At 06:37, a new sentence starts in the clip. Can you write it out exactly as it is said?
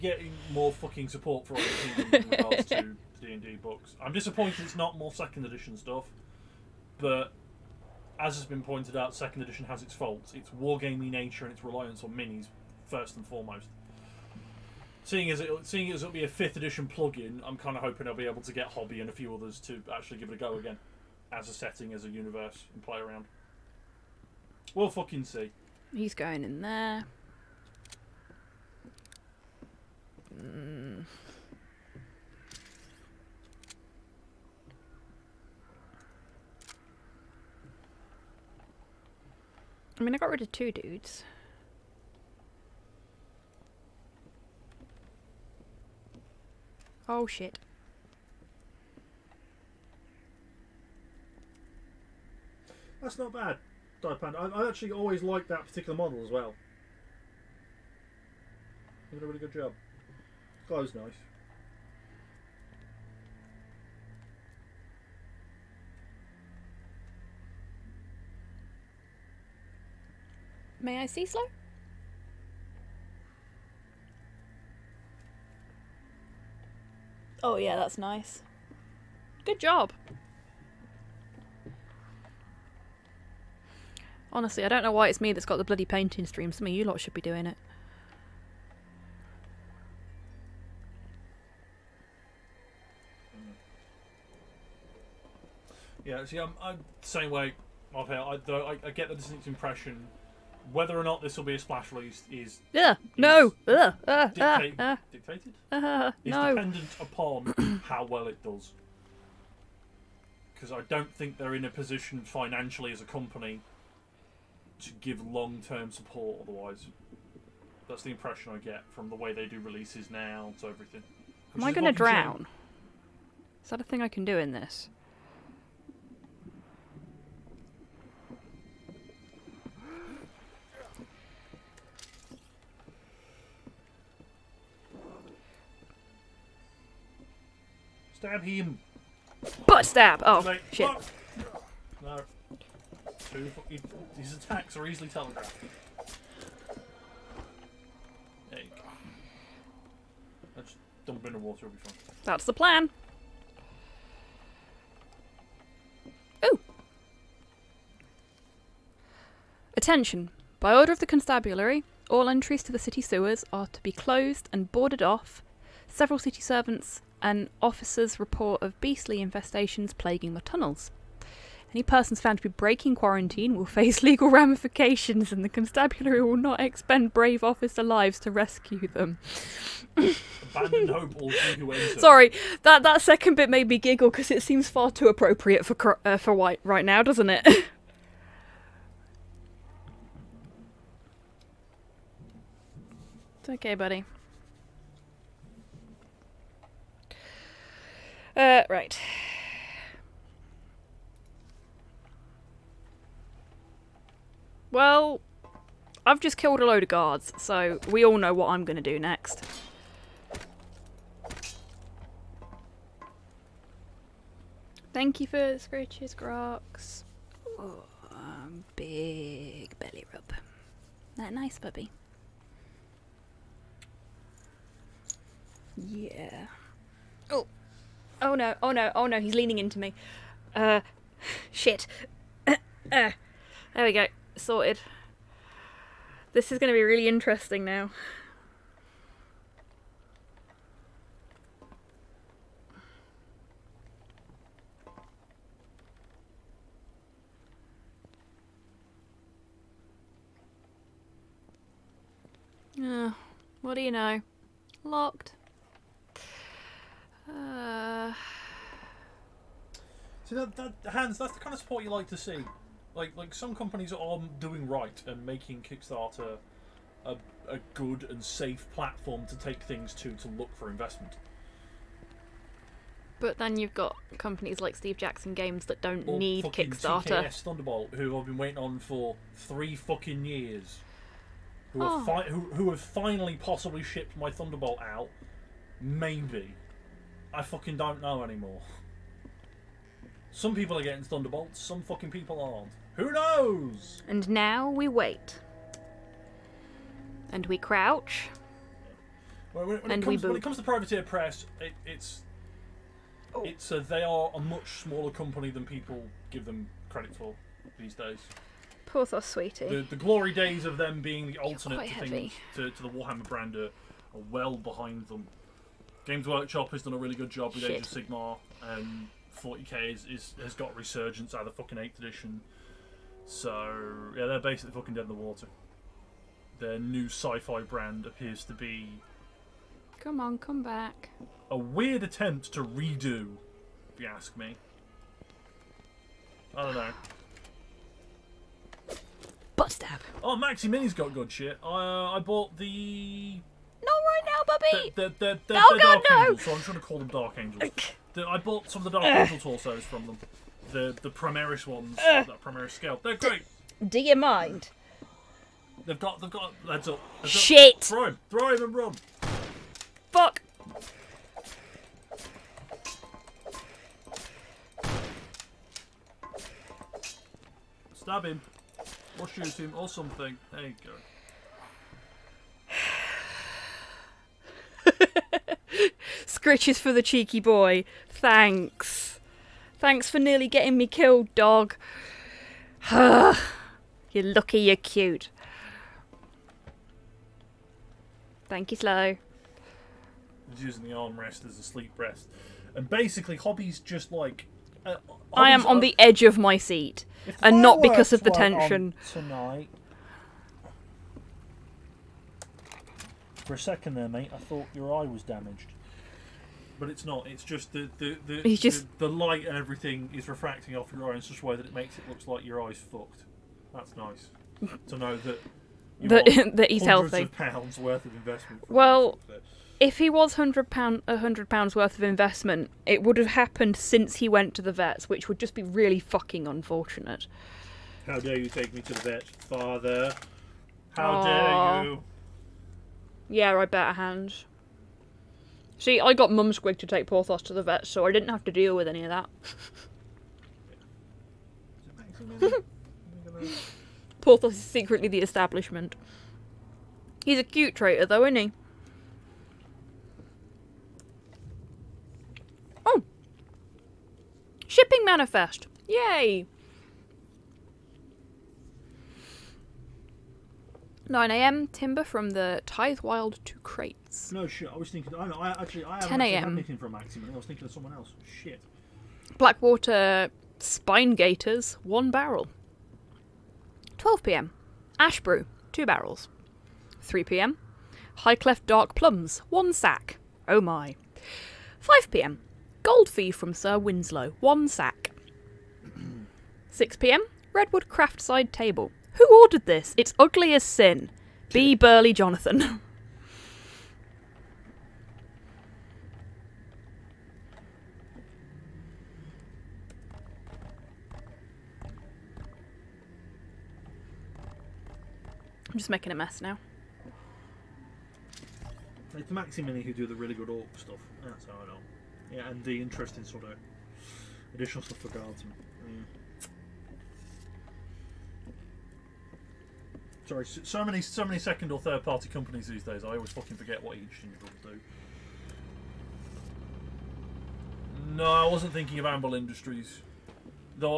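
and not because of the tension.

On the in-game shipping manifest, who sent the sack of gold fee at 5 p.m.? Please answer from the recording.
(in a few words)
Sir Winslow.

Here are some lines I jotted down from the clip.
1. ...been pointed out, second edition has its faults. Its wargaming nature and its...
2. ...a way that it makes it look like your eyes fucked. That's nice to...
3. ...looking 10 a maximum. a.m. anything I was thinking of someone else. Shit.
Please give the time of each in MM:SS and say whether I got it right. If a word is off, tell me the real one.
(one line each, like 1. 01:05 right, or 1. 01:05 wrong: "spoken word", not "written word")
1. 00:08 right
2. 06:51 right
3. 07:45 right.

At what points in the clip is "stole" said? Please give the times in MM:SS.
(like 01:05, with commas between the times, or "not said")
not said.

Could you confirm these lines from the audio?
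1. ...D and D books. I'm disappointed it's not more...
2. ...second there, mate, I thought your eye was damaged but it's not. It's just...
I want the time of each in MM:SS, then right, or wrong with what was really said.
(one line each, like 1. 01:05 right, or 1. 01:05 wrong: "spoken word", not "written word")
1. 00:03 right
2. 06:43 right.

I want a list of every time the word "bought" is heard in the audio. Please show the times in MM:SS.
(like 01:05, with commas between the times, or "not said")
05:42, 05:48.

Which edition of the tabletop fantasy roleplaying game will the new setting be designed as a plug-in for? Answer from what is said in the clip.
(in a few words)
fifth edition.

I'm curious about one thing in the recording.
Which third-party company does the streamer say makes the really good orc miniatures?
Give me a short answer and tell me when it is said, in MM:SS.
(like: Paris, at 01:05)
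Maximini, at 08:29.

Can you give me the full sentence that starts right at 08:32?
Yeah, and the interesting sort of additional stuff for guardsmen.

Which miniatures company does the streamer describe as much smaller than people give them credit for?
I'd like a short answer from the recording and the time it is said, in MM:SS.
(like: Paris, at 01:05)
Privateer Press, at 05:00.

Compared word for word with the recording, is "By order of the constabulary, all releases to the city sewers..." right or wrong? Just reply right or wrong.
wrong.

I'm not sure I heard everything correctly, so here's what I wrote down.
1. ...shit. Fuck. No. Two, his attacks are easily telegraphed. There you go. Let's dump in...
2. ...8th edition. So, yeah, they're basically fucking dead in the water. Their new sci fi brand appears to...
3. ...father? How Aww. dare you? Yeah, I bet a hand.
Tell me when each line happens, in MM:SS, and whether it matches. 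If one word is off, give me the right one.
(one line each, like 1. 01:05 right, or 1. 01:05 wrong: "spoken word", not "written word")
1. 02:20 right
2. 05:21 right
3. 07:09 right.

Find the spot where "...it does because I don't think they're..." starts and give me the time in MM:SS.
01:48.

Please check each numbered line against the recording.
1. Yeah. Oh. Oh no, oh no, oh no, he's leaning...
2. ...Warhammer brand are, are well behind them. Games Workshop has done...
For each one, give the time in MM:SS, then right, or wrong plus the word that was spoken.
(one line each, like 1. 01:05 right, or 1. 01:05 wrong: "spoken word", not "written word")
1. 03:45 right
2. 05:12 right.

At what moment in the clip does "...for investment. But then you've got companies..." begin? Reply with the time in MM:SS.
04:30.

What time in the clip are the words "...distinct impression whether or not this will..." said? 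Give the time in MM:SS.
01:39.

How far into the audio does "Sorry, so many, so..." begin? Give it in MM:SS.
08:40.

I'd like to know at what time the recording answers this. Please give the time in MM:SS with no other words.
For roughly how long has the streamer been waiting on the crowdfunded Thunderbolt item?
04:39.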